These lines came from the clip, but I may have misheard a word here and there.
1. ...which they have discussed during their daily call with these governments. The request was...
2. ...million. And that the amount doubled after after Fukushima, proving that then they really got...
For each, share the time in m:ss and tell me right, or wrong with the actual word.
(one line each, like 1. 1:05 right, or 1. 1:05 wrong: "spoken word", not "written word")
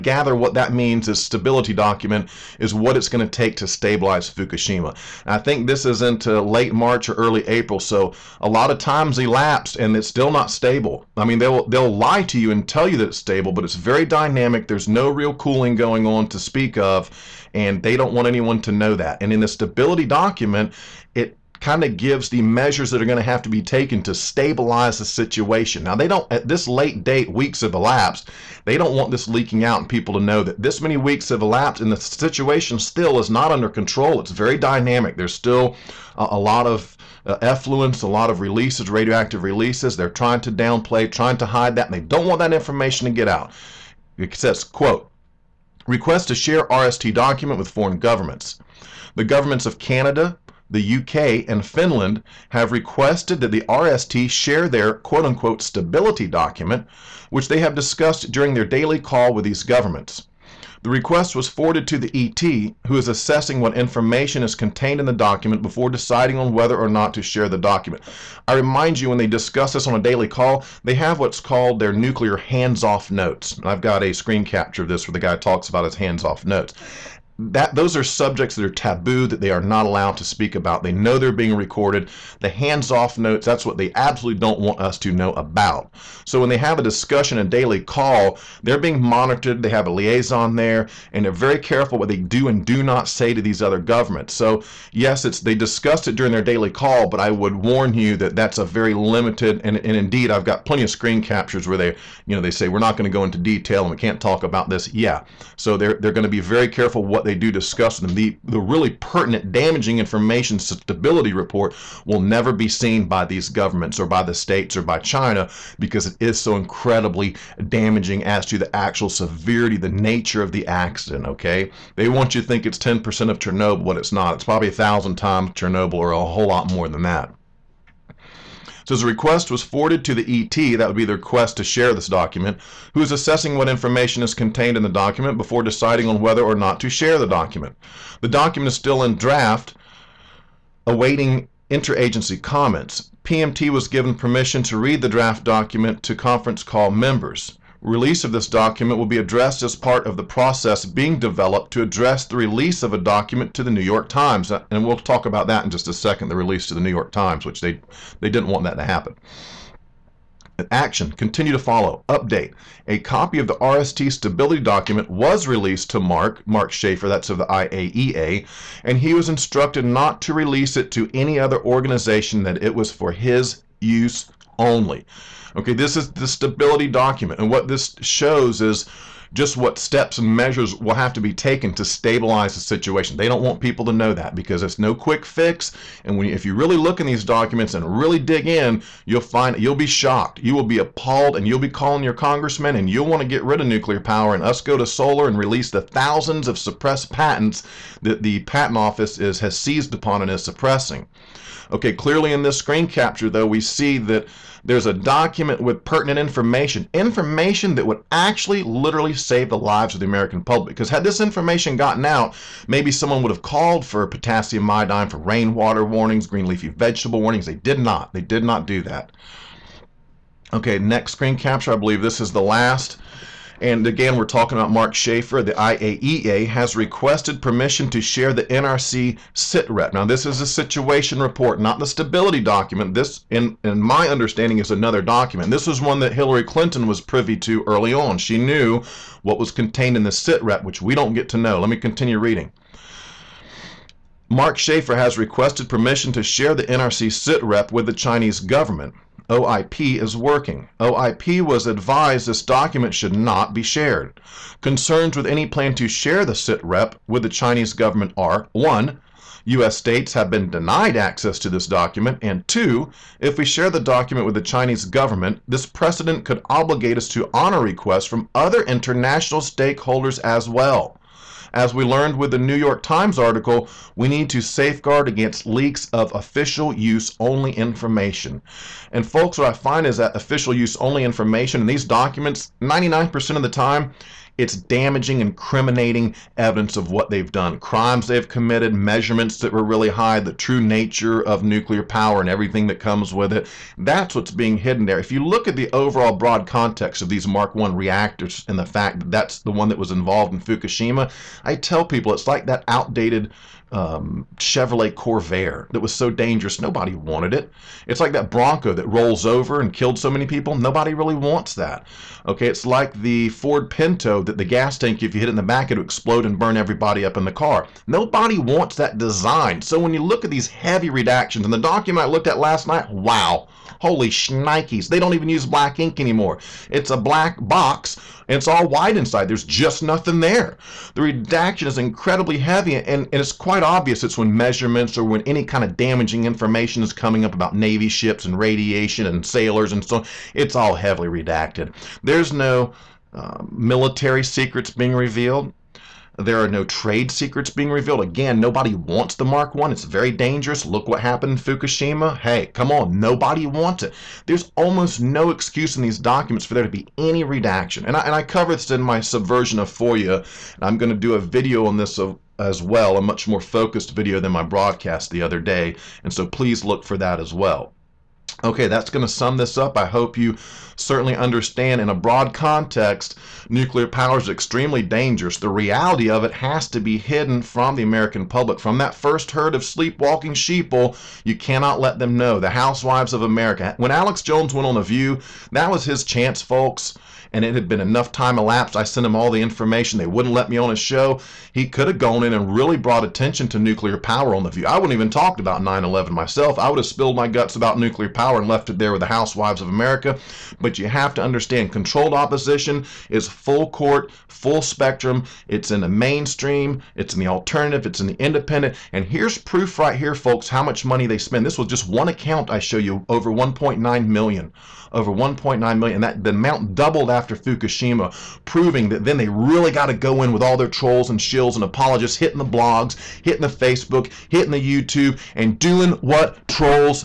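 1. 0:57 right
2. 6:55 right.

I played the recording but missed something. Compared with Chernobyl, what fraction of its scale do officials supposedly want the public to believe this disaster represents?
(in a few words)
10%.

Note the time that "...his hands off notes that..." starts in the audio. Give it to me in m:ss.
1:15.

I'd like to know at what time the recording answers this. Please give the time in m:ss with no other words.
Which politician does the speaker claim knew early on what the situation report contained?
3:56.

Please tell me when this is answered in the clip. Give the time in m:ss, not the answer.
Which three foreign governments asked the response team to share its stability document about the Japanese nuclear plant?
0:49.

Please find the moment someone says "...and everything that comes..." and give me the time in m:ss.
4:52.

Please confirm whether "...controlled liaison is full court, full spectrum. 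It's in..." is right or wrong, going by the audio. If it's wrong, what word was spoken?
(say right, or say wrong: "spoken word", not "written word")
wrong: "opposition", not "liaison".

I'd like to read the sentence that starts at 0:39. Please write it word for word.
They're trying to downplay, trying to hide that, and they don't want that information to get out.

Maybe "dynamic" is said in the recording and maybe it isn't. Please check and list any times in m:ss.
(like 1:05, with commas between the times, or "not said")
0:14, 0:34.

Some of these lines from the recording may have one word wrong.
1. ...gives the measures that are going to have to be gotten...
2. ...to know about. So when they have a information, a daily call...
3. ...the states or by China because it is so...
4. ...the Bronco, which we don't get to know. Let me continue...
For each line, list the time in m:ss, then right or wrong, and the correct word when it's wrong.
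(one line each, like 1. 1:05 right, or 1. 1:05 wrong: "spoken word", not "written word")
1. 0:21 wrong: "taken", not "gotten"
2. 1:24 wrong: "discussion", not "information"
3. 1:54 right
4. 4:00 wrong: "SITREP", not "Bronco".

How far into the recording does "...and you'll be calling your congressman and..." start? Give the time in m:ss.
3:11.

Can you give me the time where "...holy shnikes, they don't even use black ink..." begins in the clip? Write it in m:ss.
5:23.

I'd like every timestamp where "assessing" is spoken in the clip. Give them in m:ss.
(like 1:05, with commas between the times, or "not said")
1:03, 2:13.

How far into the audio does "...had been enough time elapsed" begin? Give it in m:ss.
6:27.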